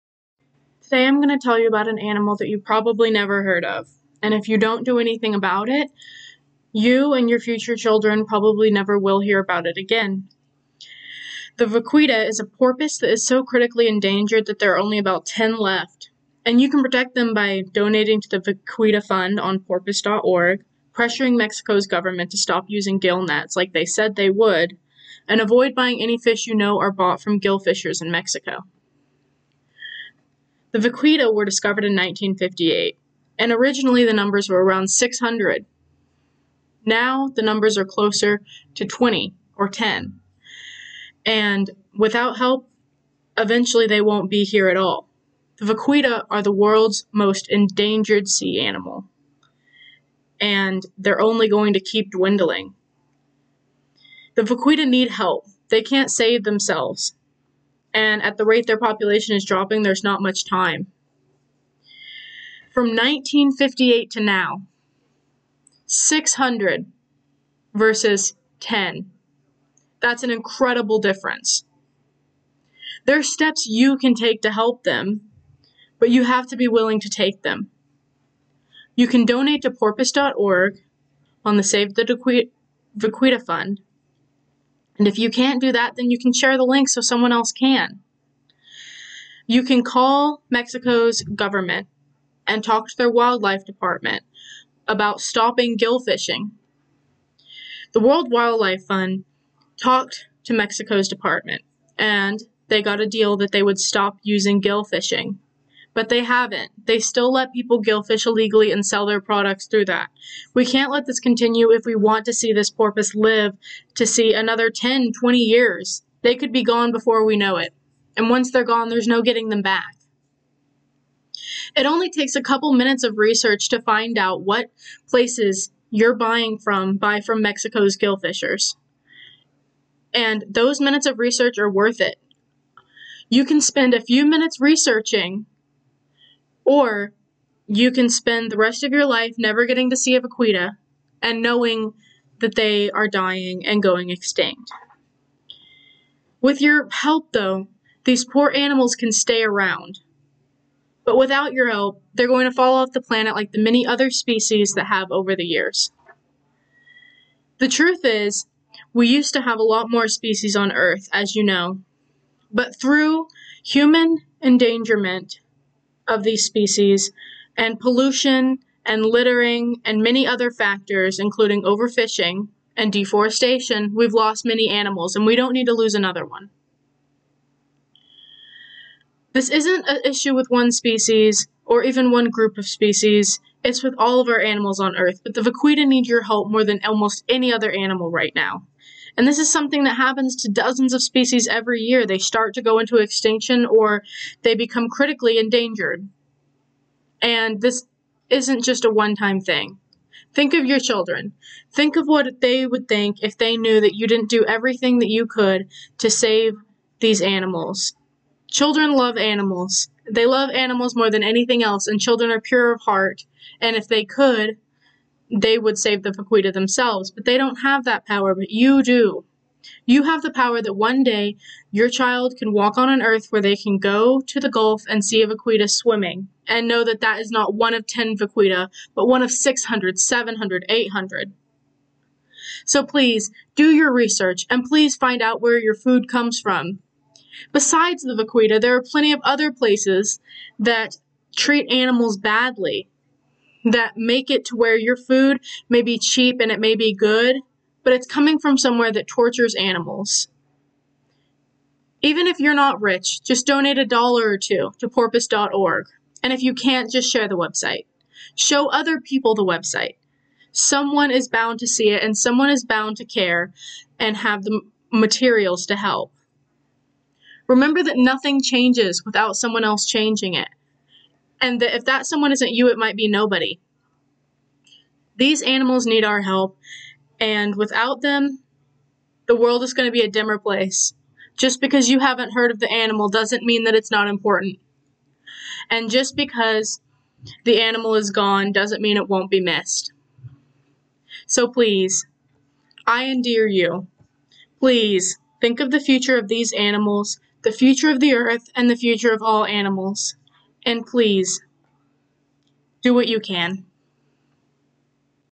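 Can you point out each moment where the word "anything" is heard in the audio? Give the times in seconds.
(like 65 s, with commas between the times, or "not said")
4 s, 211 s.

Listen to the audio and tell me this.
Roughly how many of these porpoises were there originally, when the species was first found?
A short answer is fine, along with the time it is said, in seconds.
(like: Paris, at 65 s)
600, at 34 s.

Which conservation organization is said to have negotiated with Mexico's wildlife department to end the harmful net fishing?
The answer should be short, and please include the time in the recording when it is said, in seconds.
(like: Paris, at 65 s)
World Wildlife Fund, at 97 s.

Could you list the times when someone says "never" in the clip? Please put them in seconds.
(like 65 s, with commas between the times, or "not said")
3 s, 8 s, 139 s.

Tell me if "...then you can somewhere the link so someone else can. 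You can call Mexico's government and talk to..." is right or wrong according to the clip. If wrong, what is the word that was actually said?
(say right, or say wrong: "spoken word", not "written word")
wrong: "share", not "somewhere".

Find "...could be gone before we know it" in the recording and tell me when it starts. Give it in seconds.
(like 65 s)
116 s.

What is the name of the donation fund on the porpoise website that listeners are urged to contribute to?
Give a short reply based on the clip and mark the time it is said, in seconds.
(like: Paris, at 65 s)
Save the Vaquita Fund, at 81 s.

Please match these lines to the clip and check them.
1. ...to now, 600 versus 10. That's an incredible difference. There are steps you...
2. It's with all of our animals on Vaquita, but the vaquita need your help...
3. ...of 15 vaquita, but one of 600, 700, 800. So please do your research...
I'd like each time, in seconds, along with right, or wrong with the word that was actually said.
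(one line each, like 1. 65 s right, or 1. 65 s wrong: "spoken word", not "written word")
1. 64 s right
2. 183 s wrong: "Earth", not "Vaquita"
3. 227 s wrong: "10", not "15".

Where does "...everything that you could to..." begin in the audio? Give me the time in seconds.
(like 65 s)
204 s.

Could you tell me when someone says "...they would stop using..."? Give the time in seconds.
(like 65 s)
103 s.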